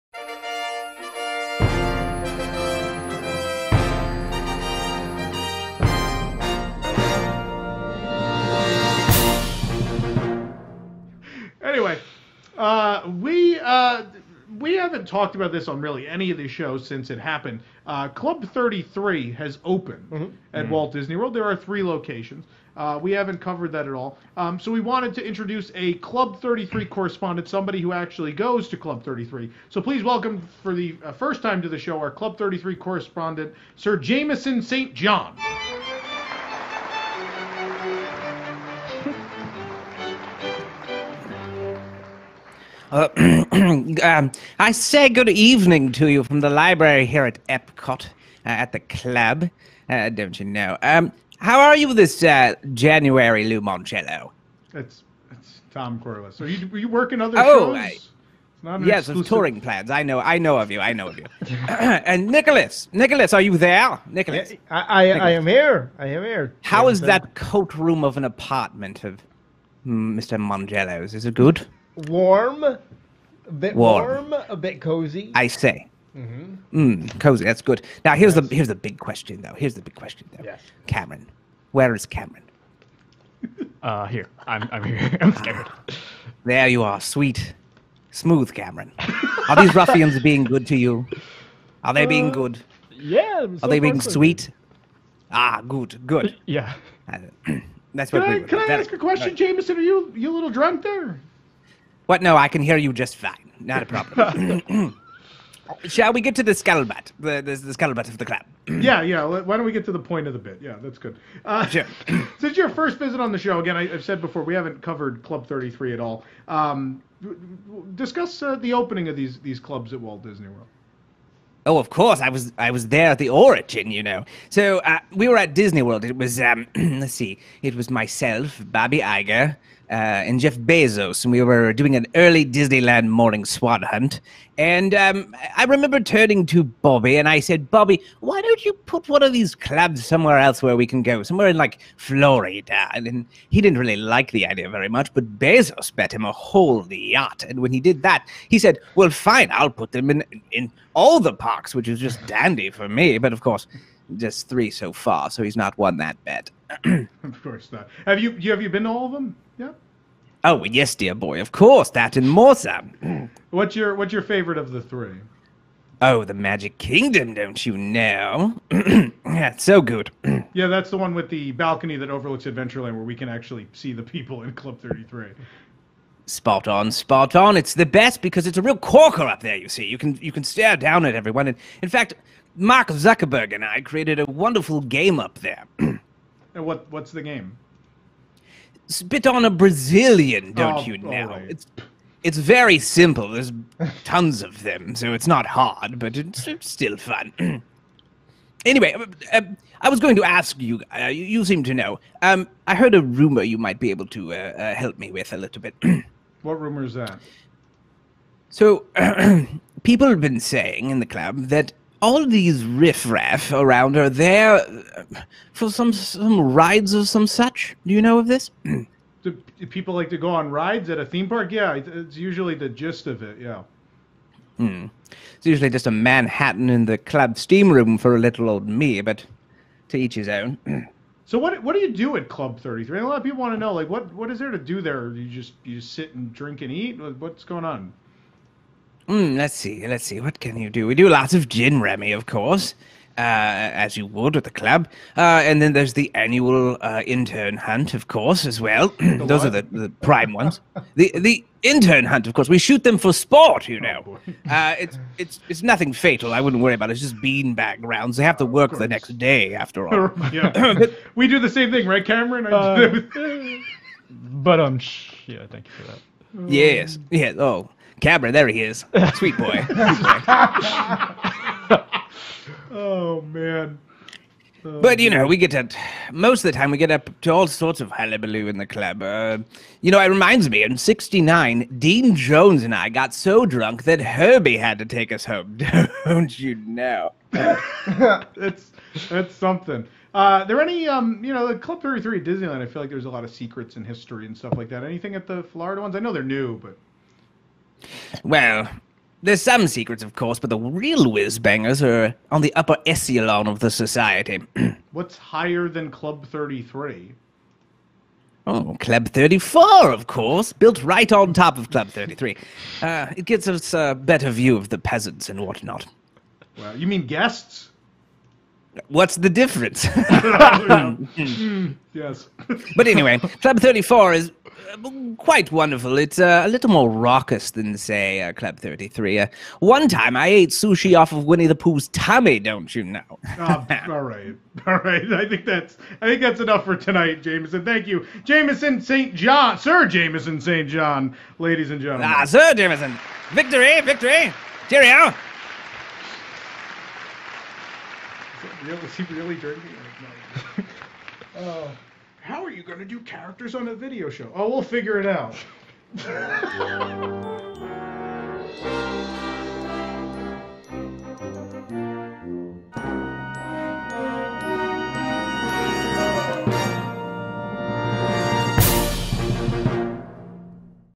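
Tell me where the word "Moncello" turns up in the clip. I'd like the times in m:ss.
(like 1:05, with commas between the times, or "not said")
0:53.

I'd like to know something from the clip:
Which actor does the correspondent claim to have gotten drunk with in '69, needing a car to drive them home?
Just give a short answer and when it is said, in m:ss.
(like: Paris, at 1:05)
Dean Jones, at 4:41.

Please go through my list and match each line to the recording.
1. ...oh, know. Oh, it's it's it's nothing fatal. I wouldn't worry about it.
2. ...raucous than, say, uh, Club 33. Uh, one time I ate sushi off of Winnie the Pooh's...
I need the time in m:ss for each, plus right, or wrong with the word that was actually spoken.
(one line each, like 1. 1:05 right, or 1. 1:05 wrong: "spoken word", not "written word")
1. 4:13 right
2. 5:26 right.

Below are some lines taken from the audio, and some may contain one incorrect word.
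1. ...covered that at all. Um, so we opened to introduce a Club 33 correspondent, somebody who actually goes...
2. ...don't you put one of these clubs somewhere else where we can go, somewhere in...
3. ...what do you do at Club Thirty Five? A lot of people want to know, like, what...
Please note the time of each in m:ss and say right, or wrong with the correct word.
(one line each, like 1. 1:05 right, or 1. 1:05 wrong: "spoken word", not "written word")
1. 0:23 wrong: "wanted", not "opened"
2. 2:18 right
3. 3:51 wrong: "Three", not "Five".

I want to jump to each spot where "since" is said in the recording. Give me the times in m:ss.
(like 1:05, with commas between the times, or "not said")
0:16, 1:52.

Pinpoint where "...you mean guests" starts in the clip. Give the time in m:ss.
5:16.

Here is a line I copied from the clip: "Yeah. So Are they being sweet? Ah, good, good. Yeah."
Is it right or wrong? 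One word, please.
right.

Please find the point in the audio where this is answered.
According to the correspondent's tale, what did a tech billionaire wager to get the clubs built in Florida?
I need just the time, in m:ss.
2:26.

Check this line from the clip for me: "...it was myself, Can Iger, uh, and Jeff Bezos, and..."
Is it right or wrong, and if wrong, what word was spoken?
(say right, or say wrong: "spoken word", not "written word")
wrong: "Bobby", not "Can".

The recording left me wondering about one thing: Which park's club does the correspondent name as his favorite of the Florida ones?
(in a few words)
Magic Kingdom.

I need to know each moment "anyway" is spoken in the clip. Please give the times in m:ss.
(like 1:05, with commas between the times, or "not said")
0:11, 3:18, 5:22.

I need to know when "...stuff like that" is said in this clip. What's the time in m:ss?
4:54.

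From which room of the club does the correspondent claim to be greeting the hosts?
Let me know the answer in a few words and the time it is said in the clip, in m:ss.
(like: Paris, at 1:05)
The library, at 0:46.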